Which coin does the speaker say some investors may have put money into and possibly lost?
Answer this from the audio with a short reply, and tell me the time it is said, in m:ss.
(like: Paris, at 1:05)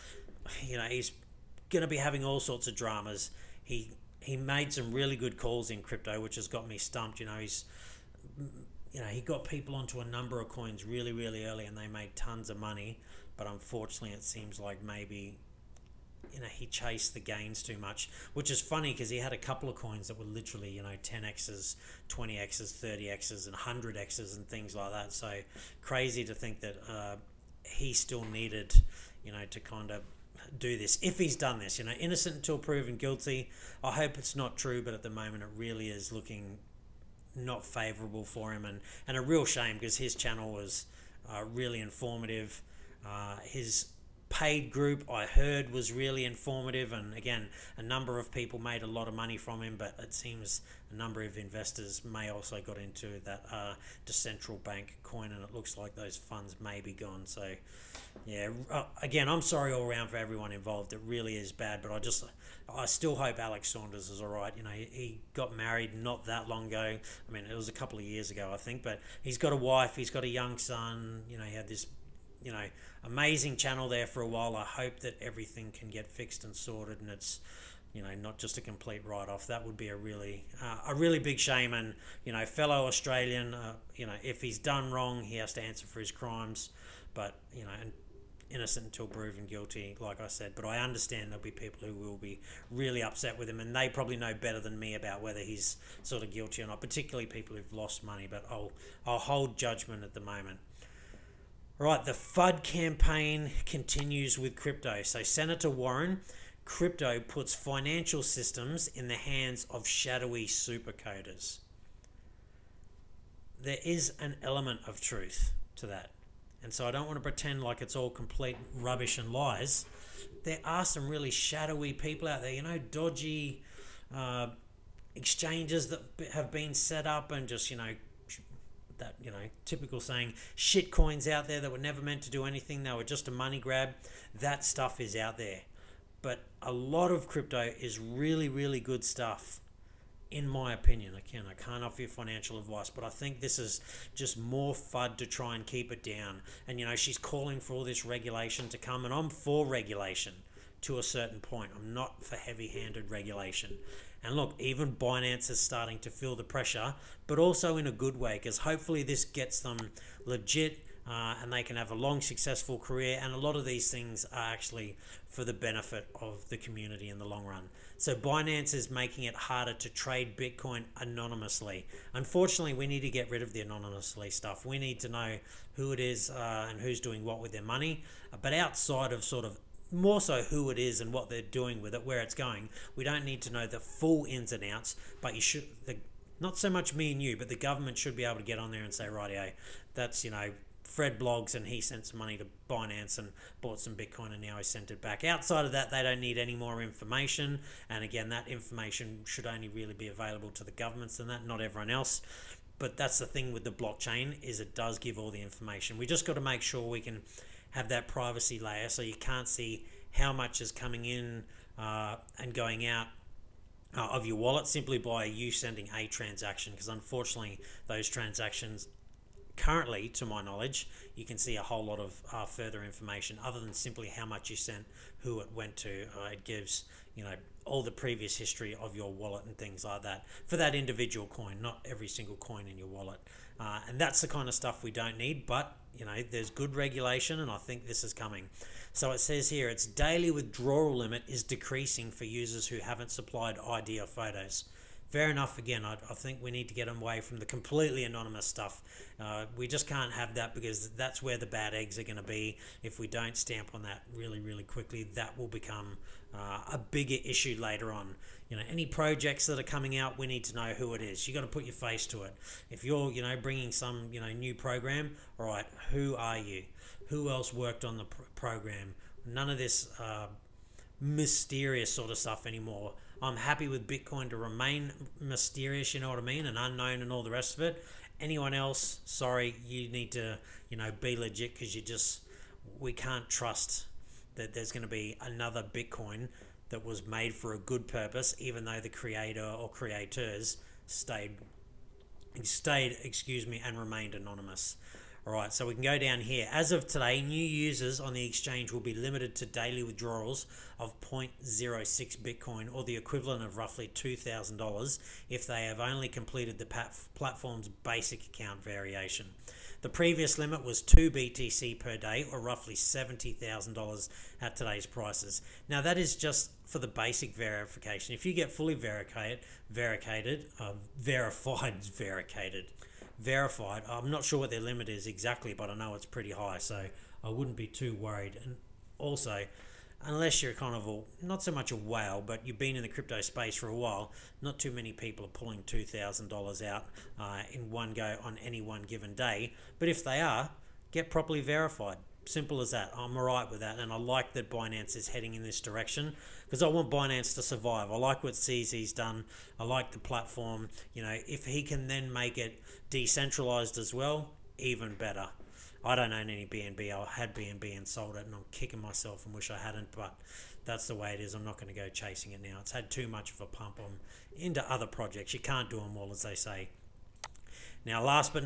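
Decentral Bank, at 0:54.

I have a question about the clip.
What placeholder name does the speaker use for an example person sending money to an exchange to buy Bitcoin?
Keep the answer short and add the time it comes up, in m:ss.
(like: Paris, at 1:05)
Fred Bloggs, at 3:10.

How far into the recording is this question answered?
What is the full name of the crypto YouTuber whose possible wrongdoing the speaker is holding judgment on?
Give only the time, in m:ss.
1:03.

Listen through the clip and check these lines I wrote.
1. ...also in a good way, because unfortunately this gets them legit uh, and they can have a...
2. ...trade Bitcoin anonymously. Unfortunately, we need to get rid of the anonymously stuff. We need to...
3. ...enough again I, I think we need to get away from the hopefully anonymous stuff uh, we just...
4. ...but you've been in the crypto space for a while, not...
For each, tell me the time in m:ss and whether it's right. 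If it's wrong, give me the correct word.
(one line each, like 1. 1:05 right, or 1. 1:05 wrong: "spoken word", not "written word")
1. 2:37 wrong: "hopefully", not "unfortunately"
2. 2:49 right
3. 4:05 wrong: "completely", not "hopefully"
4. 5:32 right.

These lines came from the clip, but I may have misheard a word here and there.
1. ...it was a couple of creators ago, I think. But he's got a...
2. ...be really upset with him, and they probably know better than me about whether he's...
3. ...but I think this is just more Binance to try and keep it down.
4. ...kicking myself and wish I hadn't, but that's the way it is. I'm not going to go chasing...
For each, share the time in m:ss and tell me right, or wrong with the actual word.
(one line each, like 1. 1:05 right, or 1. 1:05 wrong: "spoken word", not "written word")
1. 1:07 wrong: "years", not "creators"
2. 1:32 right
3. 2:22 wrong: "FUD", not "Binance"
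4. 5:58 right.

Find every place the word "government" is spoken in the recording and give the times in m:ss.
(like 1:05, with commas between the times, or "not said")
3:07, 3:20.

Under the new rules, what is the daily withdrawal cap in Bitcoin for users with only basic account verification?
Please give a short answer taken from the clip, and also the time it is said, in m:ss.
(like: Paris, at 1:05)
0.06 Bitcoin, at 5:01.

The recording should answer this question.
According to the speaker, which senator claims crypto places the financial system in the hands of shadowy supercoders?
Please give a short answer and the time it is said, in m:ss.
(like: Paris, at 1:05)
Senator Warren, at 1:45.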